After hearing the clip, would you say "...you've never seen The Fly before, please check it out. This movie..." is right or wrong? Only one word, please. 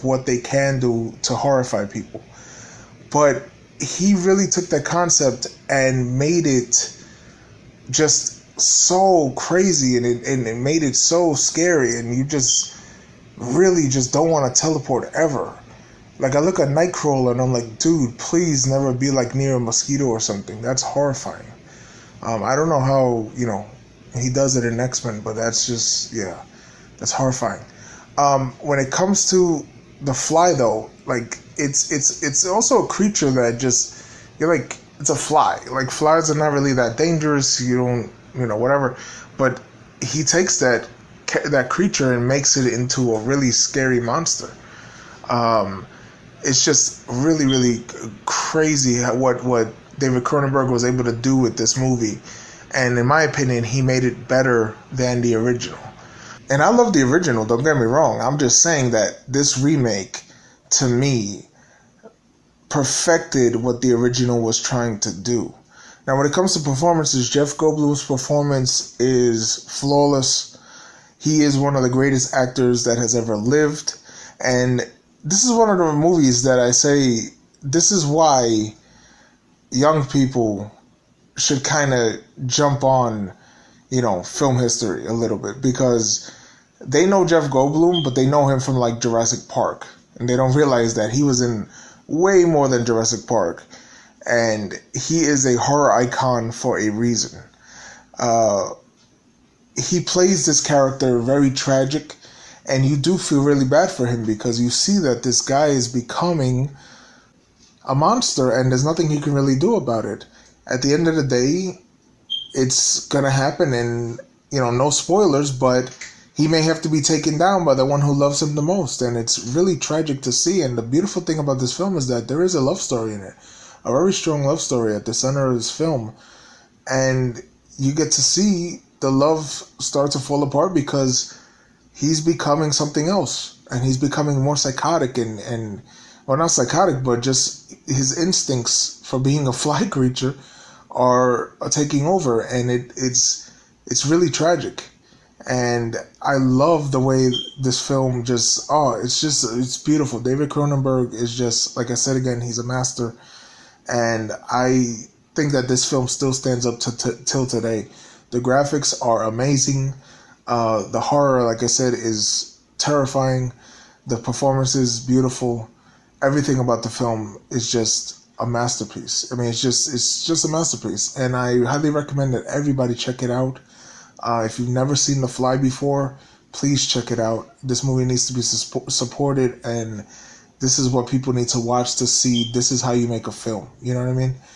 right.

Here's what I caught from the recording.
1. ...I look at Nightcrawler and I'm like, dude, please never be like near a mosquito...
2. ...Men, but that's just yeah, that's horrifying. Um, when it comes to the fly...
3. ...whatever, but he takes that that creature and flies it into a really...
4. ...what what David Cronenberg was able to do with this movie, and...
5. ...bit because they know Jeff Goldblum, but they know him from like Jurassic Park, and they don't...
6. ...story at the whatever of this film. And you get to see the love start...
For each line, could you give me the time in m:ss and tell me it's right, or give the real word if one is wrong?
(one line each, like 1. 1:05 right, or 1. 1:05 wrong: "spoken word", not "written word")
1. 0:16 right
2. 0:25 right
3. 0:38 wrong: "makes", not "flies"
4. 0:49 right
5. 1:25 right
6. 2:04 wrong: "center", not "whatever".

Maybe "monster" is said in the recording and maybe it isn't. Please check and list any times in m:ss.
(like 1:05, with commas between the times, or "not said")
0:44, 1:47.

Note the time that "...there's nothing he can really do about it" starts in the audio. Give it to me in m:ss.
1:48.